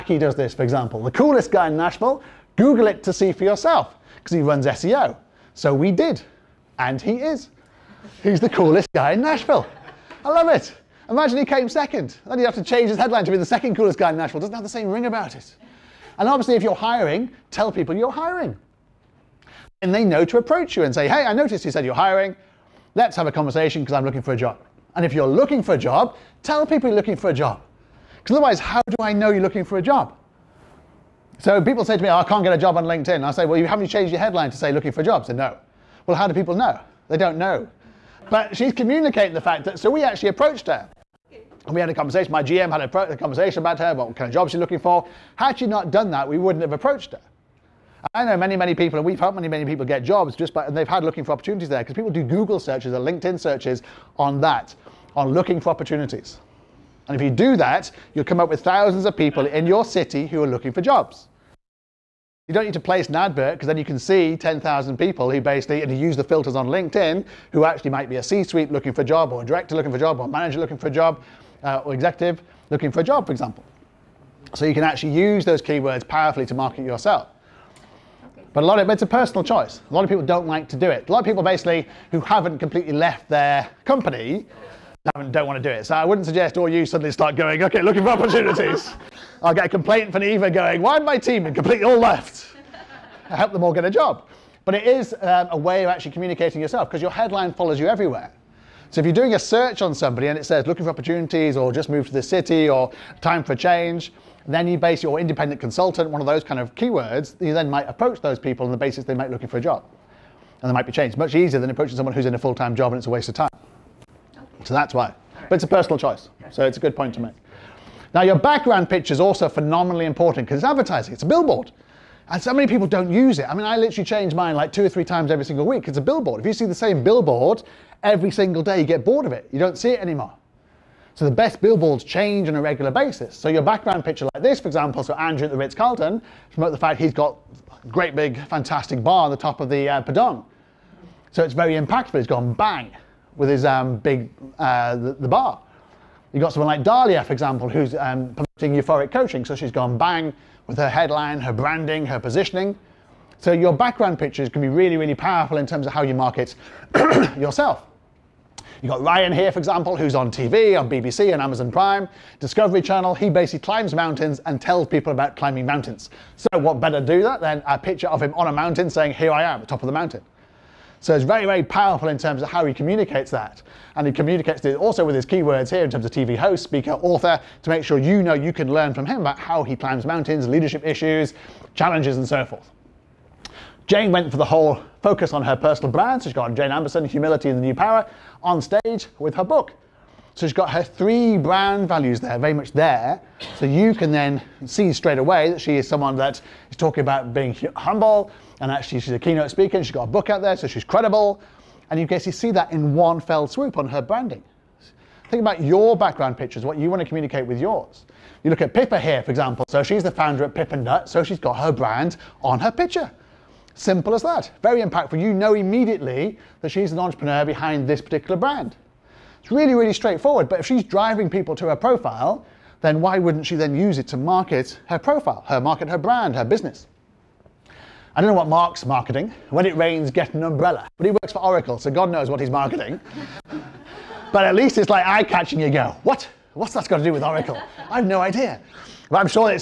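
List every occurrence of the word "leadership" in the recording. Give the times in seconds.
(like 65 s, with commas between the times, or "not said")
180 s.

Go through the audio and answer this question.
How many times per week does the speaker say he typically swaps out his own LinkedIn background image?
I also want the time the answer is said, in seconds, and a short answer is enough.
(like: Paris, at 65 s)
2 or 3, at 124 s.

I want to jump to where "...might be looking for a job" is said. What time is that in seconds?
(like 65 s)
109 s.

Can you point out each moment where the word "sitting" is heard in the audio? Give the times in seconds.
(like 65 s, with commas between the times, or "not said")
not said.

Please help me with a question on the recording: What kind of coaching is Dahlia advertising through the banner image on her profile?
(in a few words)
Euphoric coaching.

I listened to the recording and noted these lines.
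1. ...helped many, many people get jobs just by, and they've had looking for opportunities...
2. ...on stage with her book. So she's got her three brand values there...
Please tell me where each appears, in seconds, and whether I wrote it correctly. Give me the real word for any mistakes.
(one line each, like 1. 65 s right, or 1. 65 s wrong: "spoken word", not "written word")
1. 49 s right
2. 188 s right.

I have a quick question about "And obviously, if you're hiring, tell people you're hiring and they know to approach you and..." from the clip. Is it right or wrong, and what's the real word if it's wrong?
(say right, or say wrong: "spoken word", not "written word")
right.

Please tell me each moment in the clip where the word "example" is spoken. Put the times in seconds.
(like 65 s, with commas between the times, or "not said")
0 s, 73 s, 134 s, 147 s, 159 s, 209 s.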